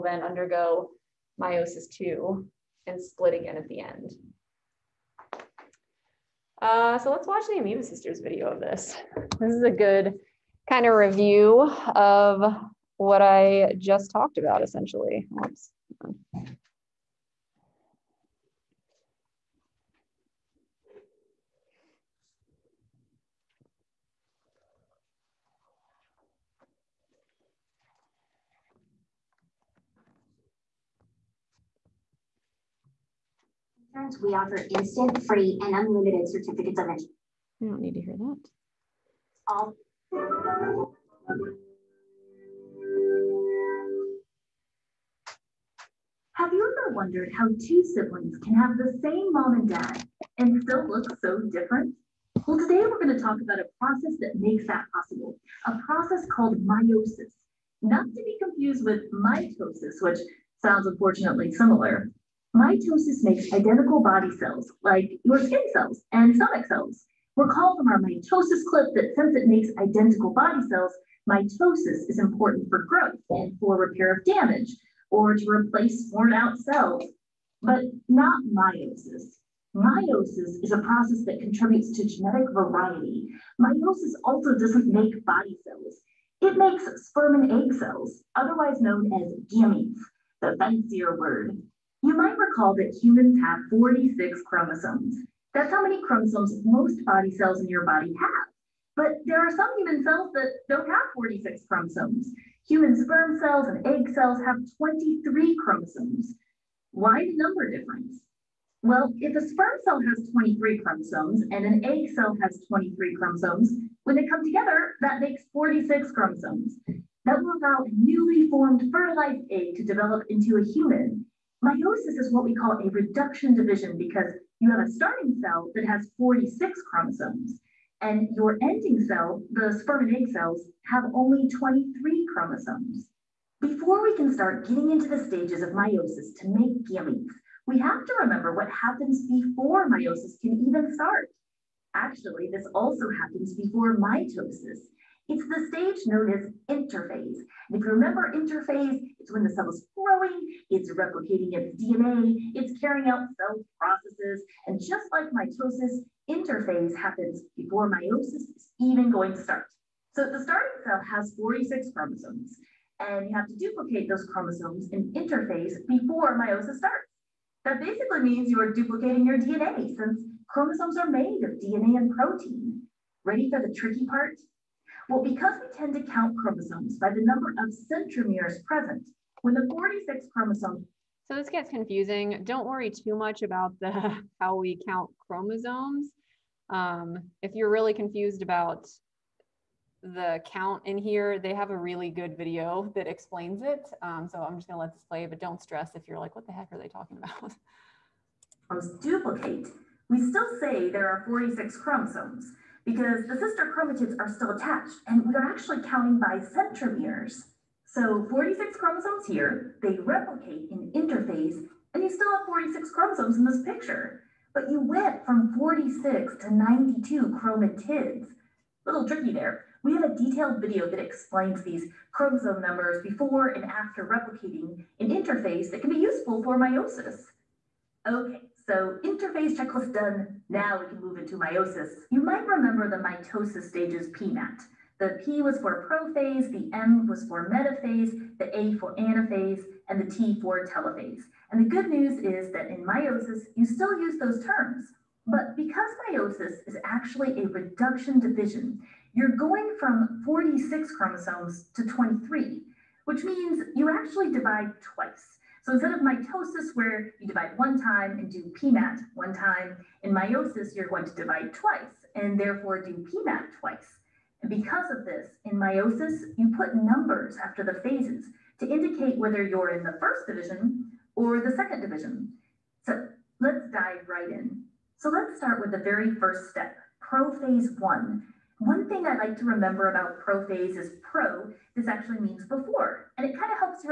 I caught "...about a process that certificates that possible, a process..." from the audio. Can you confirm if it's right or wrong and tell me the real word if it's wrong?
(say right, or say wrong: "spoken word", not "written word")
wrong: "makes", not "certificates".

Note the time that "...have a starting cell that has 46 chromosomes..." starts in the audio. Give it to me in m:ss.
2:04.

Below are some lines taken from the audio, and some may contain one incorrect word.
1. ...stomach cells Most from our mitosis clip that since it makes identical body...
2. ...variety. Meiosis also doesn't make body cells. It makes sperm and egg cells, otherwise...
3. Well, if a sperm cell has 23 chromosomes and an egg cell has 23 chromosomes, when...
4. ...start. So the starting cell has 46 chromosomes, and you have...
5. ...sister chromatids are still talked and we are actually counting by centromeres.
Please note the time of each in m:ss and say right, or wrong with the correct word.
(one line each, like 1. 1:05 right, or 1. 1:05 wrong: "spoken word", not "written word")
1. 1:06 wrong: "Recall", not "Most"
2. 1:22 right
3. 1:48 right
4. 2:39 right
5. 3:23 wrong: "attached", not "talked".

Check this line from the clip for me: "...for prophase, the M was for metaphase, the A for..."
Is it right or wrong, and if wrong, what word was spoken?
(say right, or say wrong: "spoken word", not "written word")
right.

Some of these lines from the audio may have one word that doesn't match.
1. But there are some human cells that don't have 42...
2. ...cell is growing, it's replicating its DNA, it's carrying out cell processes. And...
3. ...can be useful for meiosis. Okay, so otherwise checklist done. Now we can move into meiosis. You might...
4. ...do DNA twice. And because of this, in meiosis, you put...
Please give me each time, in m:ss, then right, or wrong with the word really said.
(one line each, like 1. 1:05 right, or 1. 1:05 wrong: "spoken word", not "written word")
1. 1:38 wrong: "46", not "42"
2. 2:29 right
3. 3:45 wrong: "interphase", not "otherwise"
4. 4:22 wrong: "PMAT", not "DNA".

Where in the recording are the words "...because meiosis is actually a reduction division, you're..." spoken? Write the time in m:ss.
4:05.